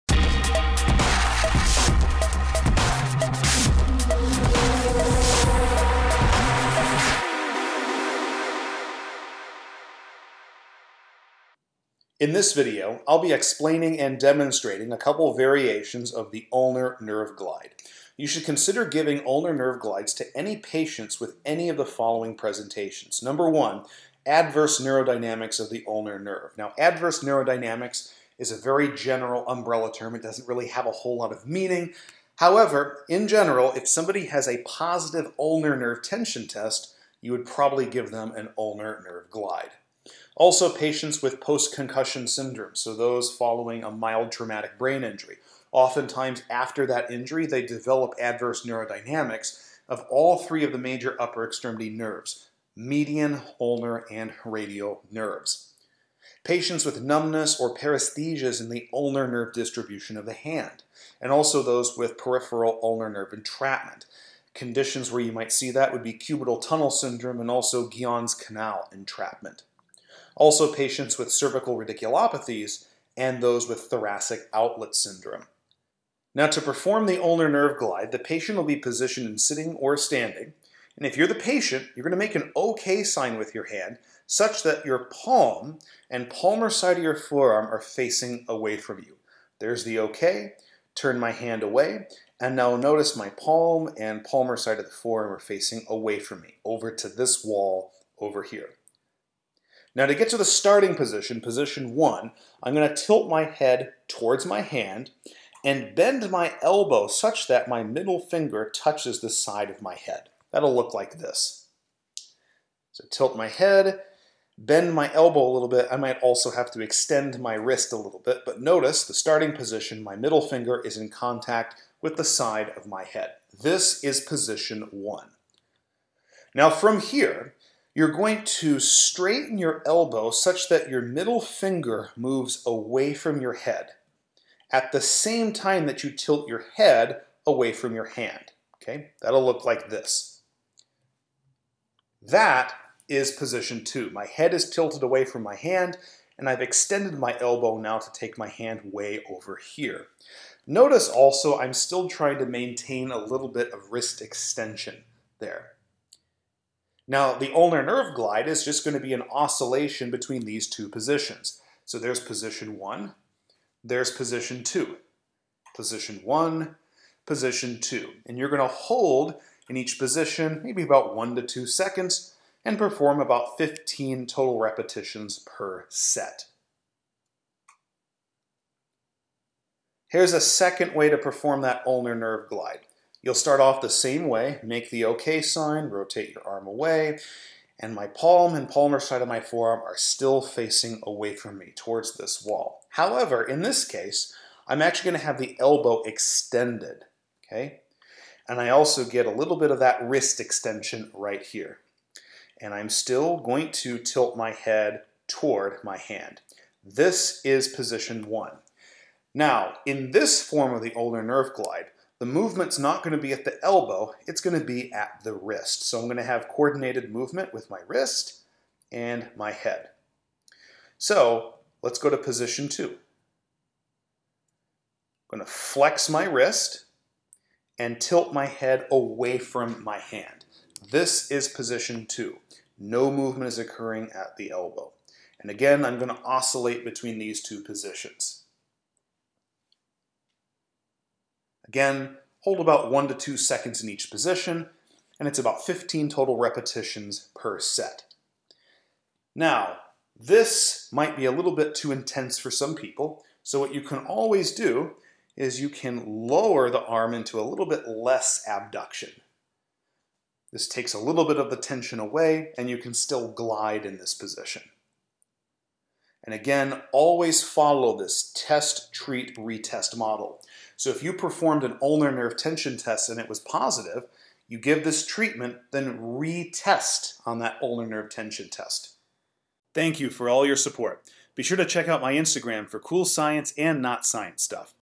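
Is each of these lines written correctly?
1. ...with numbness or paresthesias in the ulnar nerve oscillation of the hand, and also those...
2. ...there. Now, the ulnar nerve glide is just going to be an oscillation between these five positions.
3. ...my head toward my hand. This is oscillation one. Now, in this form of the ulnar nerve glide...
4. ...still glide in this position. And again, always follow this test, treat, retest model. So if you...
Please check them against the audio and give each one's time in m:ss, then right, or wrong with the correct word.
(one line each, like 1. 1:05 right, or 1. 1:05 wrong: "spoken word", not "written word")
1. 0:56 wrong: "distribution", not "oscillation"
2. 2:35 wrong: "two", not "five"
3. 3:24 wrong: "position", not "oscillation"
4. 4:22 right.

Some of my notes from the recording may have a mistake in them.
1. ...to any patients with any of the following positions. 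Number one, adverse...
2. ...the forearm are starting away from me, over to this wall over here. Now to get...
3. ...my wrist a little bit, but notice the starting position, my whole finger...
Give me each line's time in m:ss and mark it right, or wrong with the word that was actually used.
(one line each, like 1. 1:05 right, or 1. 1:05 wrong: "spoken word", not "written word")
1. 0:20 wrong: "presentations", not "positions"
2. 1:34 wrong: "facing", not "starting"
3. 1:57 wrong: "middle", not "whole".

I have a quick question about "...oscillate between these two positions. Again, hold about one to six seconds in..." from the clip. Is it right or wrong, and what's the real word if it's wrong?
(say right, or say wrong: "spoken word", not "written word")
wrong: "two", not "six".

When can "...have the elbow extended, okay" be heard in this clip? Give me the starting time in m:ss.
3:15.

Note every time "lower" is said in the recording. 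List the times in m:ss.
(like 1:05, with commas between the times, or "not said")
4:16.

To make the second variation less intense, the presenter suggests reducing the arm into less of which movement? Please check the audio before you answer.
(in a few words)
Abduction.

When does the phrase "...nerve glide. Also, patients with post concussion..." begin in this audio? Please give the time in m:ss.
0:39.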